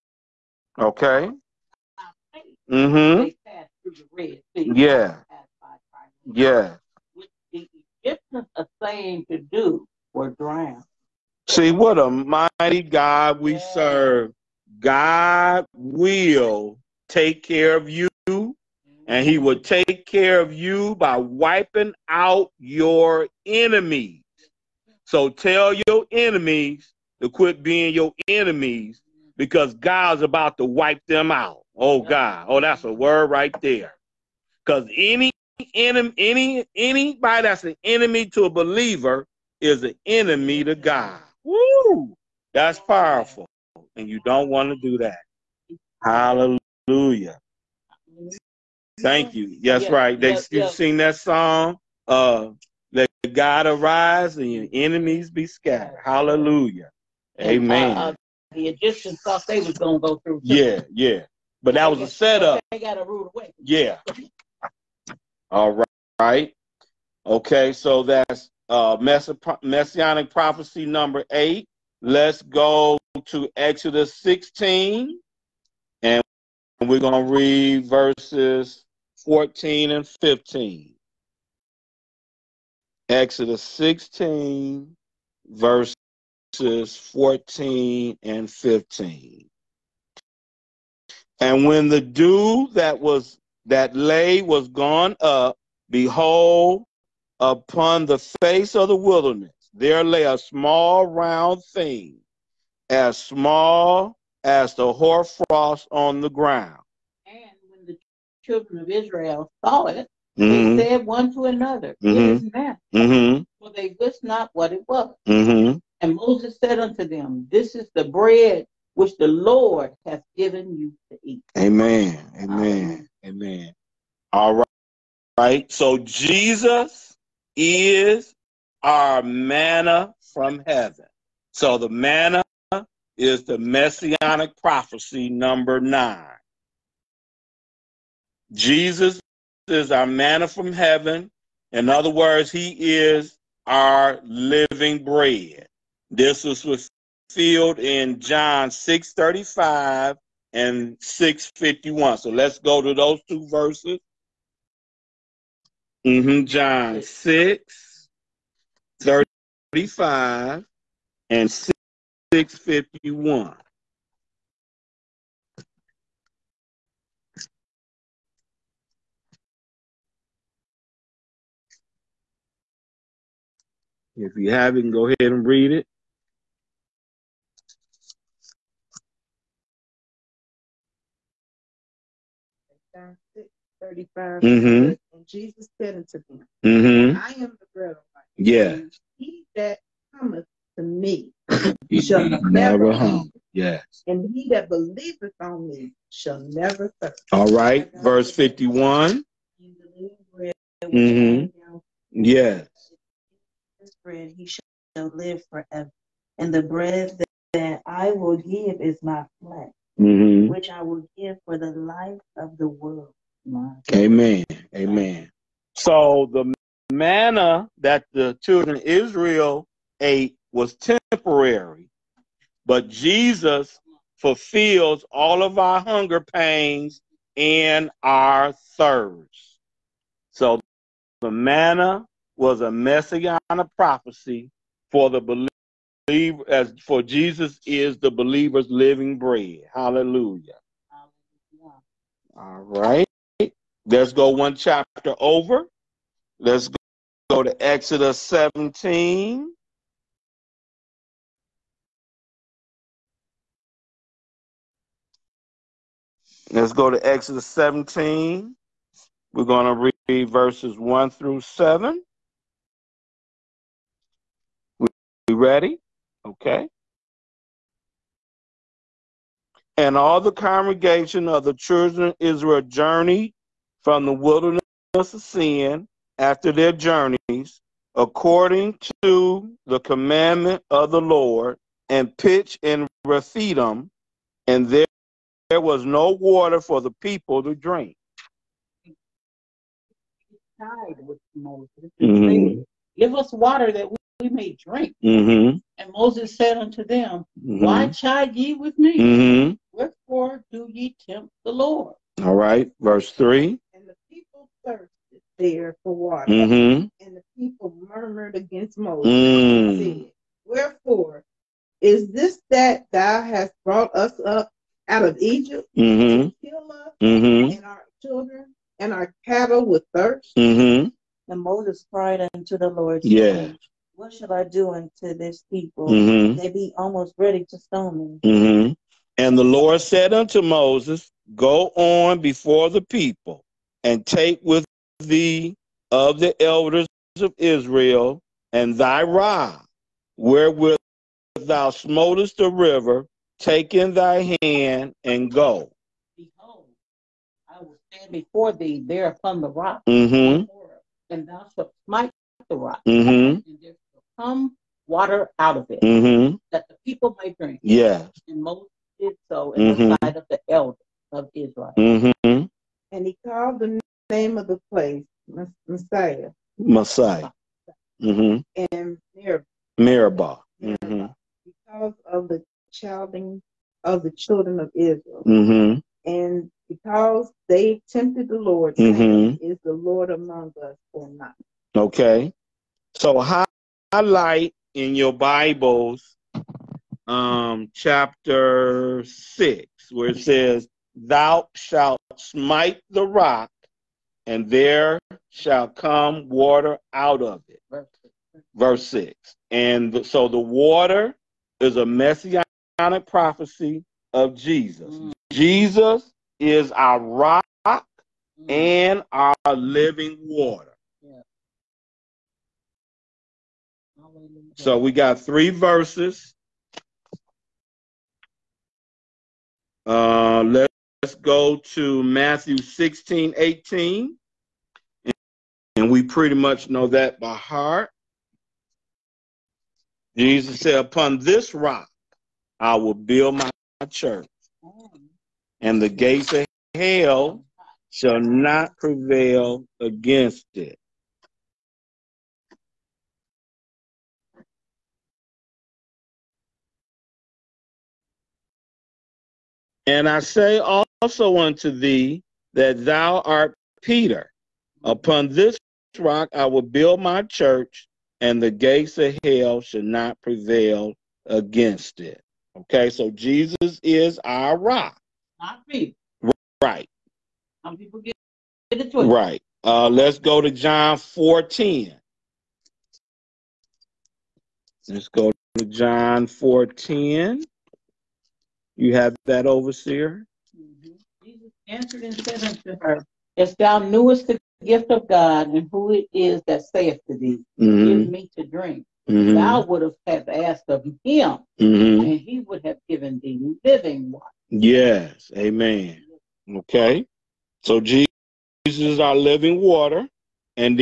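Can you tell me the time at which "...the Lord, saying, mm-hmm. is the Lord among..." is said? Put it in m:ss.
6:18.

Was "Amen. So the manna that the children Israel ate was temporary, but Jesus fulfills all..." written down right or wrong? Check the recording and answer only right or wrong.
right.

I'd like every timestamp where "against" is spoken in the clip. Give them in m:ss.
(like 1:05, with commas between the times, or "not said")
5:08, 7:19, 7:41.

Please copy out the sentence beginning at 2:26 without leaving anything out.
This was fulfilled in John 6:35 and 6:51.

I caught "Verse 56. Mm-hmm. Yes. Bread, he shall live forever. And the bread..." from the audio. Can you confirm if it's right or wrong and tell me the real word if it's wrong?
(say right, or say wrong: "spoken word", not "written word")
wrong: "51", not "56".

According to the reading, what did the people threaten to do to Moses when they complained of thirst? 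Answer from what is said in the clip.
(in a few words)
stone me.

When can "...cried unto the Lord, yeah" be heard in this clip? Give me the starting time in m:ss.
5:21.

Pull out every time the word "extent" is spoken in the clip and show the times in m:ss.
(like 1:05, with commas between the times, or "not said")
not said.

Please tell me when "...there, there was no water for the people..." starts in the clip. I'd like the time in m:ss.
4:44.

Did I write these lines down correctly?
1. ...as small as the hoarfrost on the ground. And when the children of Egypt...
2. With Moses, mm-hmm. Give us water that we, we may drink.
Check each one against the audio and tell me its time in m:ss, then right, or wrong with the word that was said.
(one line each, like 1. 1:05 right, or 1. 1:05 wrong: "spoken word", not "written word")
1. 1:42 wrong: "Israel", not "Egypt"
2. 4:50 right.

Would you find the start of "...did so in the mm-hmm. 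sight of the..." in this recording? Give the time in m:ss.
5:58.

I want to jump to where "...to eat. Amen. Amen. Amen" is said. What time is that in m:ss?
2:01.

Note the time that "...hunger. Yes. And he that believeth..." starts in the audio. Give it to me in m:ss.
3:12.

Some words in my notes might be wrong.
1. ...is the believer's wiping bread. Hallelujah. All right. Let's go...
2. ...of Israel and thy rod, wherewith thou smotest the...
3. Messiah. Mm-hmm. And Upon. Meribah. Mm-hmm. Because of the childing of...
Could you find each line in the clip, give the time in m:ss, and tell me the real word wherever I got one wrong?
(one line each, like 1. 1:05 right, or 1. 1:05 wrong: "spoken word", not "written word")
1. 3:57 wrong: "living", not "wiping"
2. 5:37 right
3. 6:06 wrong: "Meribah", not "Upon".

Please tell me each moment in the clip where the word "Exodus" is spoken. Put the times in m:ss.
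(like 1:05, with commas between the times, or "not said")
1:13, 1:23, 4:07, 4:17.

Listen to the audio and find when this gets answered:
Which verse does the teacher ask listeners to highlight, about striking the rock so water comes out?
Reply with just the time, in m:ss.
6:38.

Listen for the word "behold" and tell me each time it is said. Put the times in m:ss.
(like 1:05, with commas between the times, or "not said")
1:35, 5:46.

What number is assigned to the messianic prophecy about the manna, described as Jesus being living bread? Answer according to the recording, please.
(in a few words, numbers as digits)
9.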